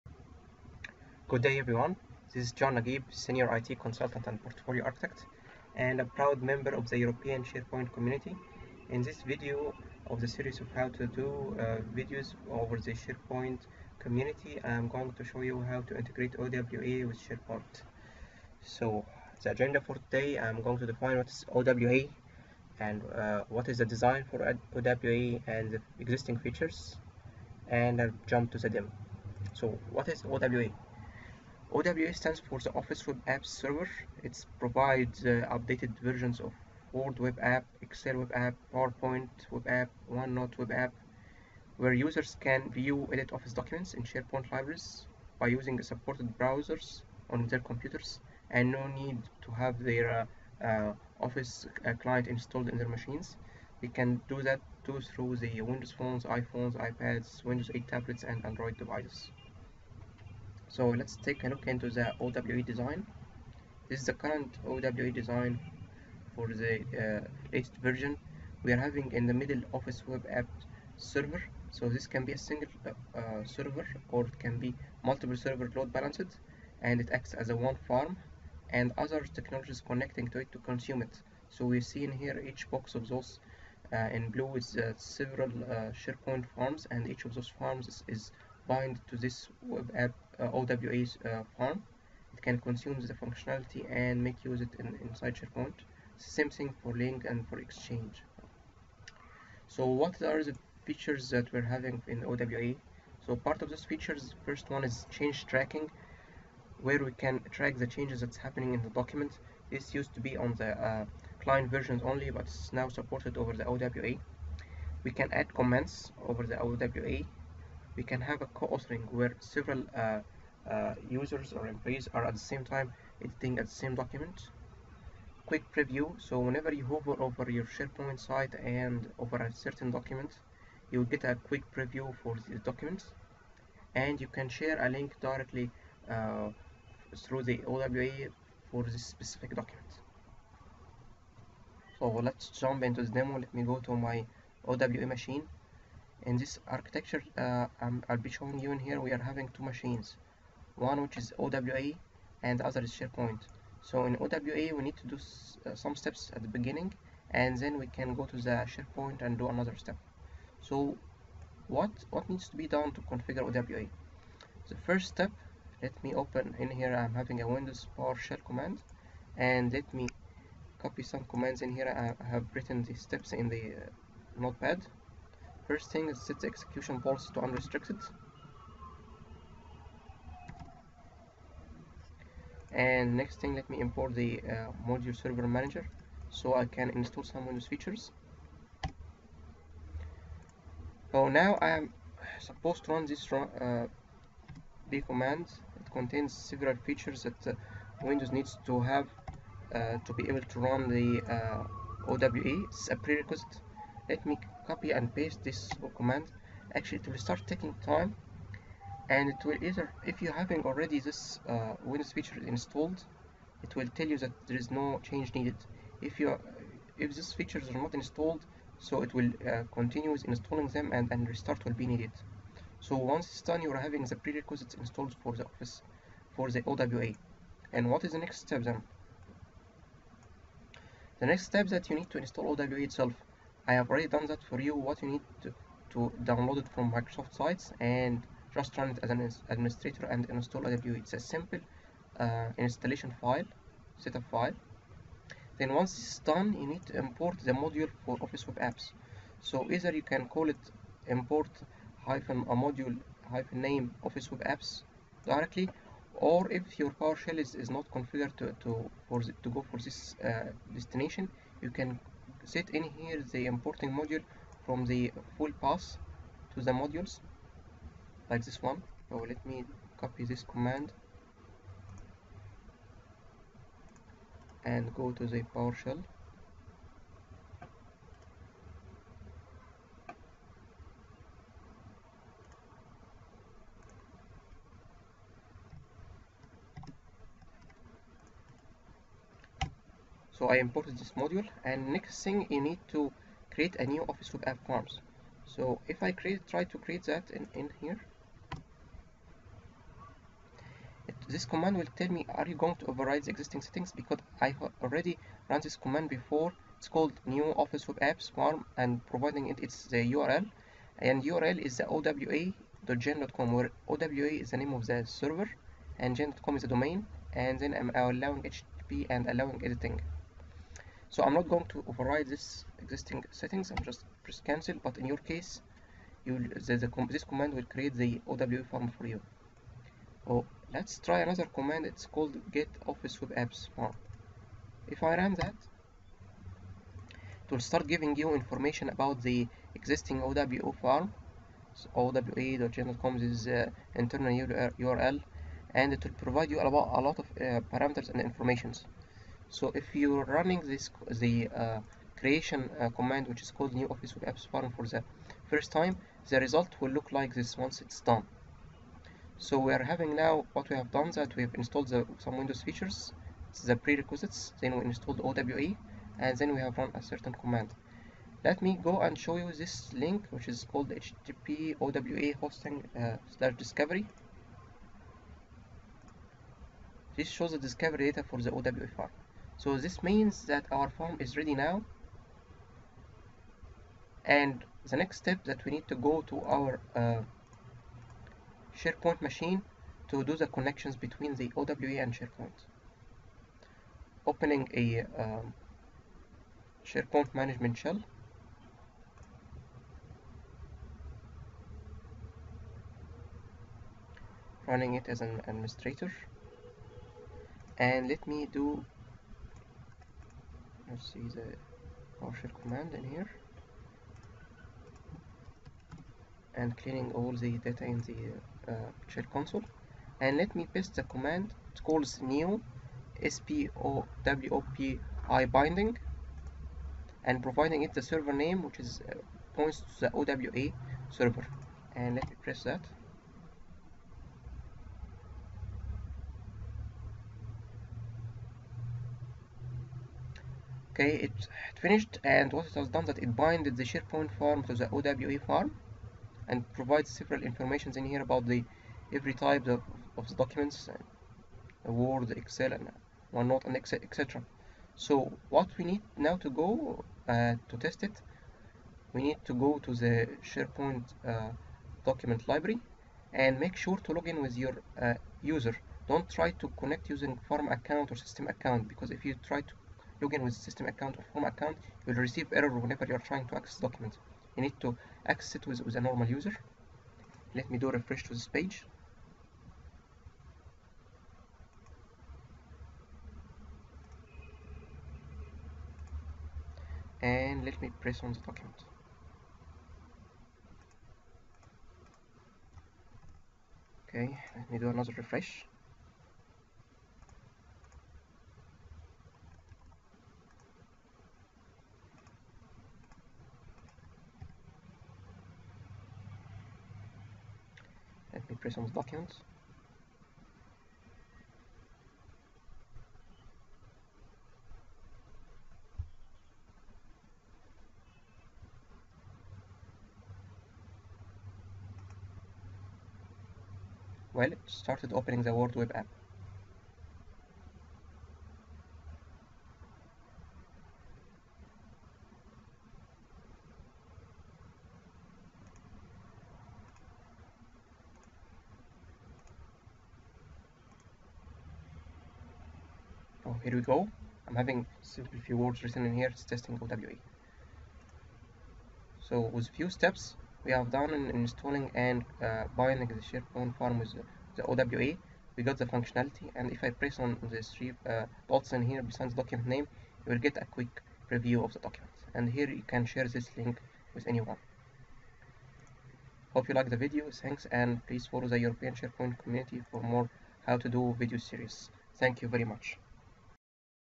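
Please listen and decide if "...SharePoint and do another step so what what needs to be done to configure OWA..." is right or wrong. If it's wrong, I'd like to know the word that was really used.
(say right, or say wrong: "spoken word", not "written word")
right.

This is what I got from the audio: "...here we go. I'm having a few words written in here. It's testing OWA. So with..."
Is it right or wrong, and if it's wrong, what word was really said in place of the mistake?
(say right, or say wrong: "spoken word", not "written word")
right.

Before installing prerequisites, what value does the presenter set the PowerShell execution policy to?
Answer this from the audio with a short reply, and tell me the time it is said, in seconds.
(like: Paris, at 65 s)
Unrestricted, at 177 s.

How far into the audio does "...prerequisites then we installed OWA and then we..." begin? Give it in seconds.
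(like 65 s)
363 s.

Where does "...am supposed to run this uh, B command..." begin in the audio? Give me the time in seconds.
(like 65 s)
191 s.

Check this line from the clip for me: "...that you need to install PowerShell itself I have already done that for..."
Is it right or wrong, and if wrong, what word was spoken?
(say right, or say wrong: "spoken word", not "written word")
wrong: "OWA", not "PowerShell".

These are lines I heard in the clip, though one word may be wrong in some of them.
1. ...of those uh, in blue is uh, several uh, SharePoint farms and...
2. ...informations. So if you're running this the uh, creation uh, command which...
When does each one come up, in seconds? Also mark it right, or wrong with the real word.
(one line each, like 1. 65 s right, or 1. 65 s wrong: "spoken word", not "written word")
1. 82 s right
2. 348 s right.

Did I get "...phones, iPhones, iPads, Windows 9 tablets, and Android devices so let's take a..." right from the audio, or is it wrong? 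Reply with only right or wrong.
wrong.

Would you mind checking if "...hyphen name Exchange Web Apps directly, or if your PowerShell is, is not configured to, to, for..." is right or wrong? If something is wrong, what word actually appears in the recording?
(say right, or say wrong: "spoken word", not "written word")
wrong: "Office", not "Exchange".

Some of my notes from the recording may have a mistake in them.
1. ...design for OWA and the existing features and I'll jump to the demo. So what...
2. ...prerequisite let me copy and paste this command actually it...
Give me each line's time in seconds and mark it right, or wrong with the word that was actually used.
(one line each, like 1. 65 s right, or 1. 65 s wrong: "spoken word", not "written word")
1. 23 s right
2. 202 s right.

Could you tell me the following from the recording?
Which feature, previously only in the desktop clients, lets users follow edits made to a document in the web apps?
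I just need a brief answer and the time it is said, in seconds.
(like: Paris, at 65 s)
Change tracking, at 105 s.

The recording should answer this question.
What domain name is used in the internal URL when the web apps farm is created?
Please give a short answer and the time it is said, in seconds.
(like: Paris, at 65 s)
gen.com, at 316 s.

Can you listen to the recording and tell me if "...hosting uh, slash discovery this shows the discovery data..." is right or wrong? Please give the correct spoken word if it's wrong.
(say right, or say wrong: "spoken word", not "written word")
right.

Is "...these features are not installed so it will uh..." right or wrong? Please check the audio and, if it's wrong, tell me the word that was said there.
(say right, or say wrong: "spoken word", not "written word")
right.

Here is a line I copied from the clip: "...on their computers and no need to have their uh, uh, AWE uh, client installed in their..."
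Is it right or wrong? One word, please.
wrong.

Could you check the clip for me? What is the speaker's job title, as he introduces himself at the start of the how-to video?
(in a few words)
Senior IT Consultant.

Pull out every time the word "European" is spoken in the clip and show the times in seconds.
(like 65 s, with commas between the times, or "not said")
6 s, 568 s.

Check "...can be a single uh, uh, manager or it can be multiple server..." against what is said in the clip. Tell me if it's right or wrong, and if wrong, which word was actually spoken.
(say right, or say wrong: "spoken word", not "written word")
wrong: "server", not "manager".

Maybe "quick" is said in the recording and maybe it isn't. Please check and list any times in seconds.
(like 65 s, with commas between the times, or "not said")
125 s, 131 s, 560 s.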